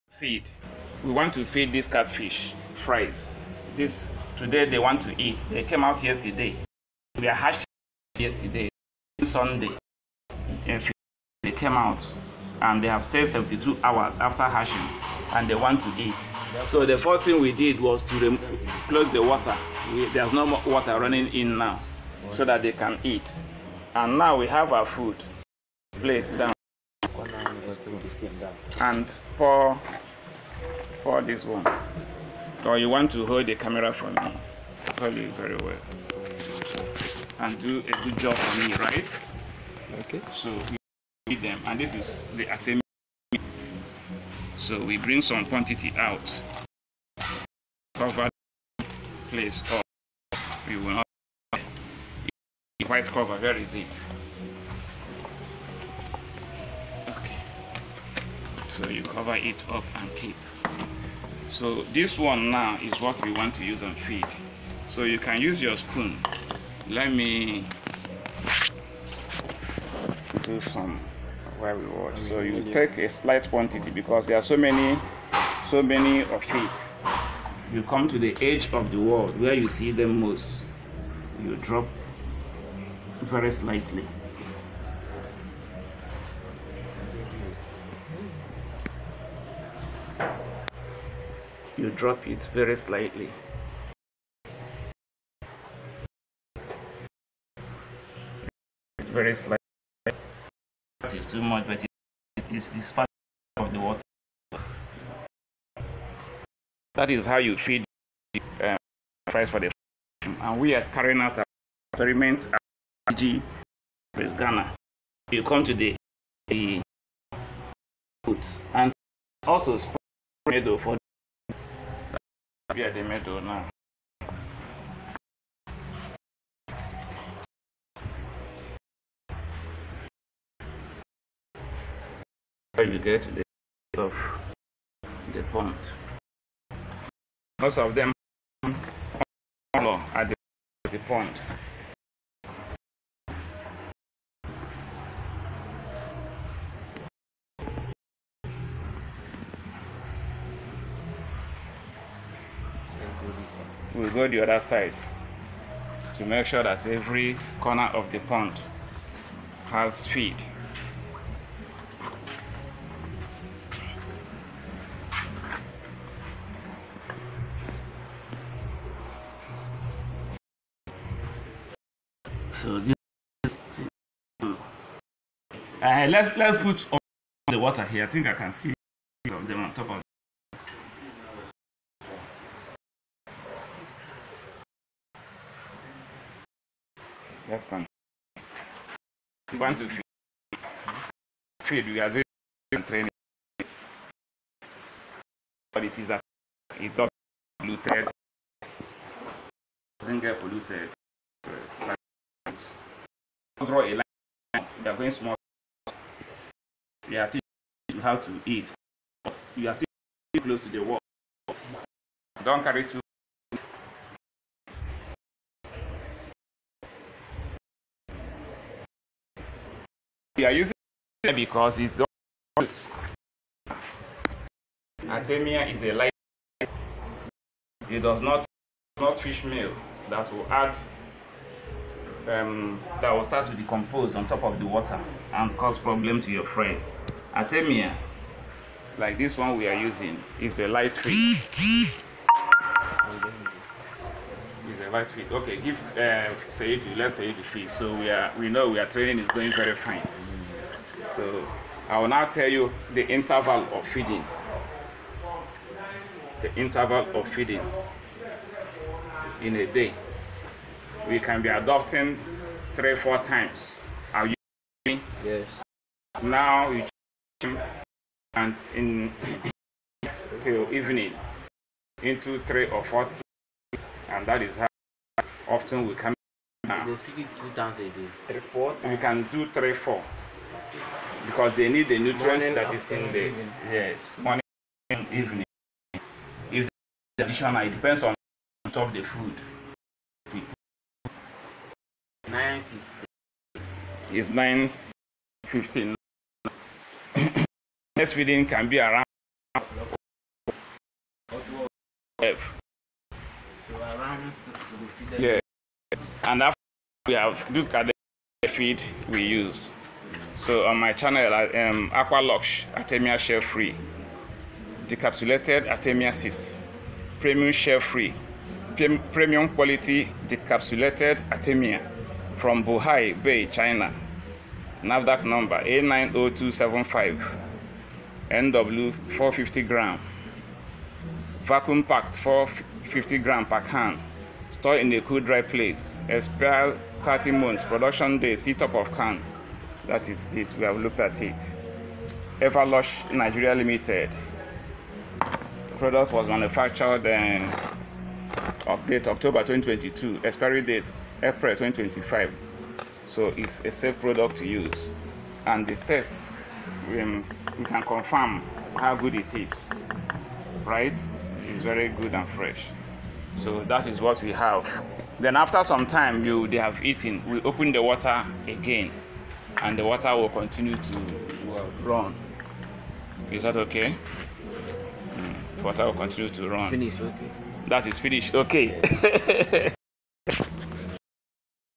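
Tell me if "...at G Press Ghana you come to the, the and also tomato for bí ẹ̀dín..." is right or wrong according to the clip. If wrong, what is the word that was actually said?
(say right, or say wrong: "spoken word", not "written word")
right.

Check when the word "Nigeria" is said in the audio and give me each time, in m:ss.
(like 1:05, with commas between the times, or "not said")
5:43.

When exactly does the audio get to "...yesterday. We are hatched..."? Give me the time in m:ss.
0:06.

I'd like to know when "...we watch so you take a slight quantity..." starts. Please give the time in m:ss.
1:11.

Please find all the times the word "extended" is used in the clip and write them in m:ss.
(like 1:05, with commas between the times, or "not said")
not said.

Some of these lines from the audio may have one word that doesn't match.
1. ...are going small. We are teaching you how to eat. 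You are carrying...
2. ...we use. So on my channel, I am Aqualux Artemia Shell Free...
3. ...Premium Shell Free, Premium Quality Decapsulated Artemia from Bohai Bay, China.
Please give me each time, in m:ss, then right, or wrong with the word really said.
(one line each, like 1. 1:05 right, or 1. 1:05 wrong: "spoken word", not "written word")
1. 3:24 wrong: "sitting", not "carrying"
2. 5:09 right
3. 5:17 right.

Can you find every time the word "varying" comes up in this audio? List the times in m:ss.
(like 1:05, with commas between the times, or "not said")
not said.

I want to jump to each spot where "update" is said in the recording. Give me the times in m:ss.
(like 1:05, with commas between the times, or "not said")
5:48.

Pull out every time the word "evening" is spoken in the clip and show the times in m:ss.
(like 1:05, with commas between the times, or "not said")
4:30, 4:45.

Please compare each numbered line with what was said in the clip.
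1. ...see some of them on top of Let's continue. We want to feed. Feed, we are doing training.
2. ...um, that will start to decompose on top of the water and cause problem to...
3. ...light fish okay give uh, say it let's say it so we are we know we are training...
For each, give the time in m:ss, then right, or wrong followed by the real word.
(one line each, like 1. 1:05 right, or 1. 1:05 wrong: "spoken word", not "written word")
1. 2:58 right
2. 3:52 right
3. 4:04 right.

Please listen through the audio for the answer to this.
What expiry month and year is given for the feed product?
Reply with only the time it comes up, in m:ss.
5:51.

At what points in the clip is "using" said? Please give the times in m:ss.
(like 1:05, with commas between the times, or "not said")
3:40, 3:59.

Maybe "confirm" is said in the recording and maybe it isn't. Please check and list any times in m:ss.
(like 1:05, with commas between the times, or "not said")
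5:57.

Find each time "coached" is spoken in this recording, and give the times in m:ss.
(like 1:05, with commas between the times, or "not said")
not said.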